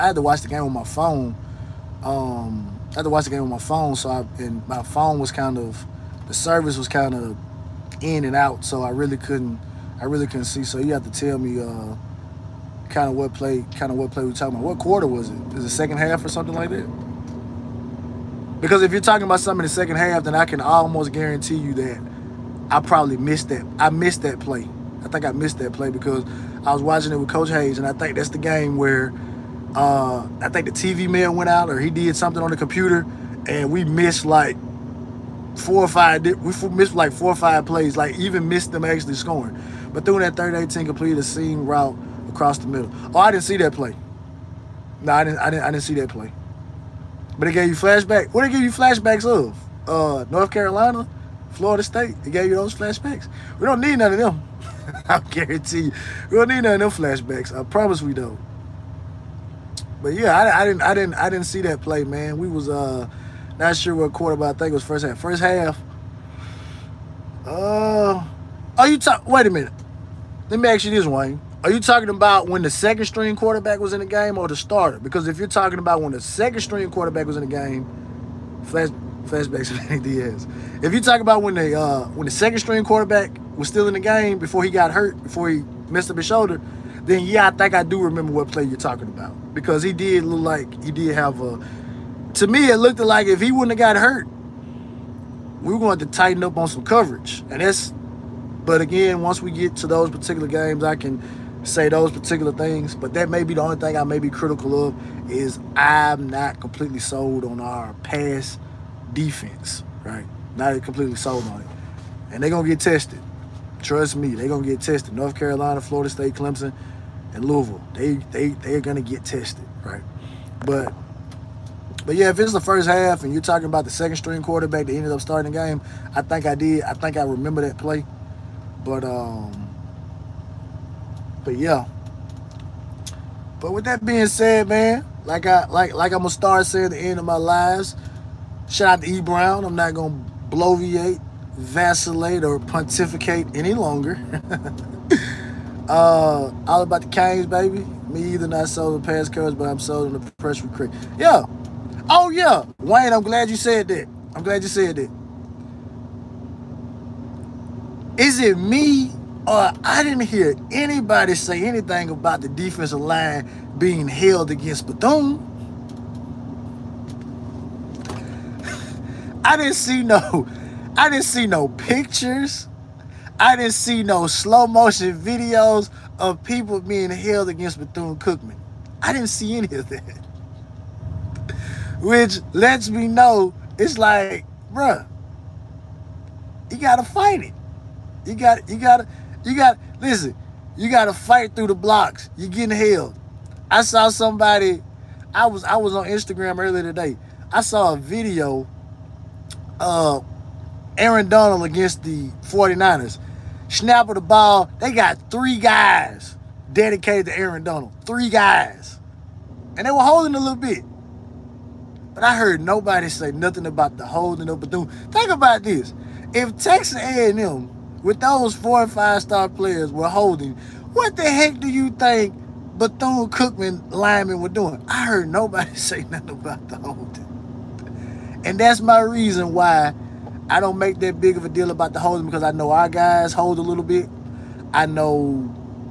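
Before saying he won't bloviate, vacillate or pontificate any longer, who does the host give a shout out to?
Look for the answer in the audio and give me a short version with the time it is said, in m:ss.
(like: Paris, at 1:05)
E Brown, at 2:19.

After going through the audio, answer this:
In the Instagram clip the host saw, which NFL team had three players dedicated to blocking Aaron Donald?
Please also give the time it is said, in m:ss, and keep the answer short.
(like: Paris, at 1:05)
49ers, at 3:22.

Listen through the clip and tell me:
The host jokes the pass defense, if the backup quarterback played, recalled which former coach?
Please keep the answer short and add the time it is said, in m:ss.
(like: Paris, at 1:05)
Manny Diaz, at 1:19.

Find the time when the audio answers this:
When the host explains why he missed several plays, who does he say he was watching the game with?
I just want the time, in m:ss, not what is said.
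0:27.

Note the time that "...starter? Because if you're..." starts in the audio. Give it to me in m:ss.
1:14.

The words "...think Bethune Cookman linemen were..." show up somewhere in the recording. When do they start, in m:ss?
3:41.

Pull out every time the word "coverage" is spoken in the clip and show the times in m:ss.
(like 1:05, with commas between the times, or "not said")
1:36.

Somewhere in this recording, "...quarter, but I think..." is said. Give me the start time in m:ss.
1:04.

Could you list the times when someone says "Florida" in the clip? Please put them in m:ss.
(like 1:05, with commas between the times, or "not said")
0:51, 1:55.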